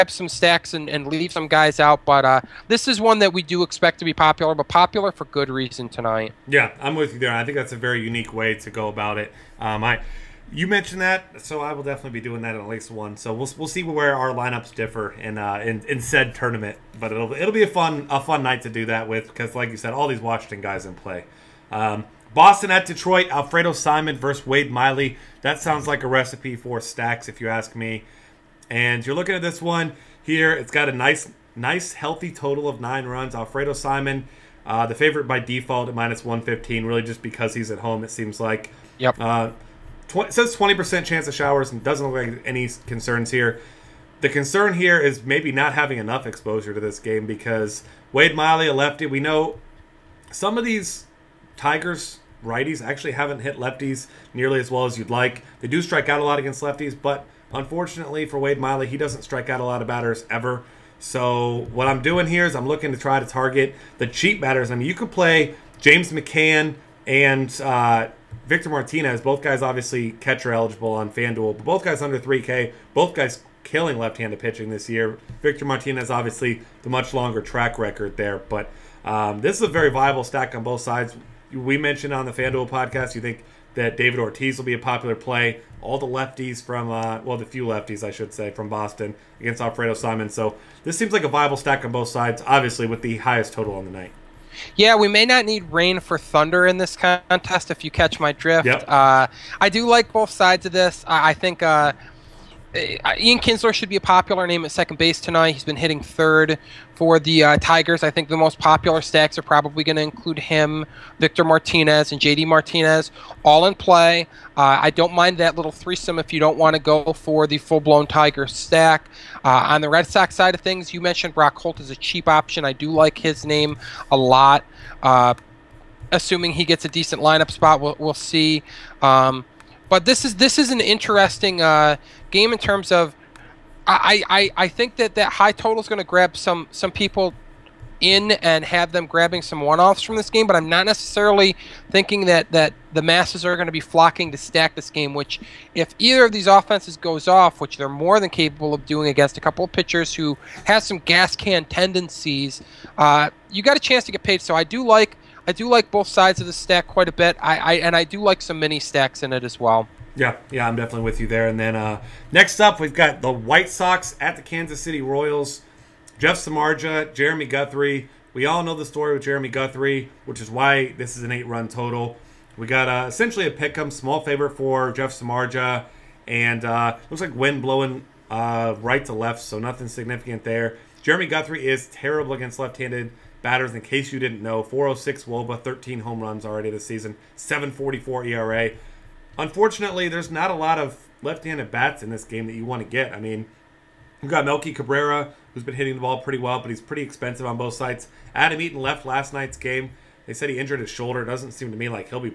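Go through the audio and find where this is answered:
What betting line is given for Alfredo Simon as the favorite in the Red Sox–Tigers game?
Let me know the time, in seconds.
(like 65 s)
35 s.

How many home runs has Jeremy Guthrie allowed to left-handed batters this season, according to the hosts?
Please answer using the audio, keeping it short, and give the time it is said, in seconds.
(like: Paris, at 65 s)
13, at 185 s.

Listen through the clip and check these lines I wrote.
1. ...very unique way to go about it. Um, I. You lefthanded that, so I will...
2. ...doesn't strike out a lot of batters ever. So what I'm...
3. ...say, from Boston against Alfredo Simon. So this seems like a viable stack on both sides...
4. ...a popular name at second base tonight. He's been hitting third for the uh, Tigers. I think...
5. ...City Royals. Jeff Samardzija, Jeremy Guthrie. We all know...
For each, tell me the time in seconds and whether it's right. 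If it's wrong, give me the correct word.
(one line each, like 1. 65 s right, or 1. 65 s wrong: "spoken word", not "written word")
1. 7 s wrong: "mentioned", not "lefthanded"
2. 58 s right
3. 88 s right
4. 103 s right
5. 164 s right.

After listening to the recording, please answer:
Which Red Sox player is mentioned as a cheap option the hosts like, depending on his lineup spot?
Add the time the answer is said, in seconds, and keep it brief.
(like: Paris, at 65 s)
Brock Holt, at 121 s.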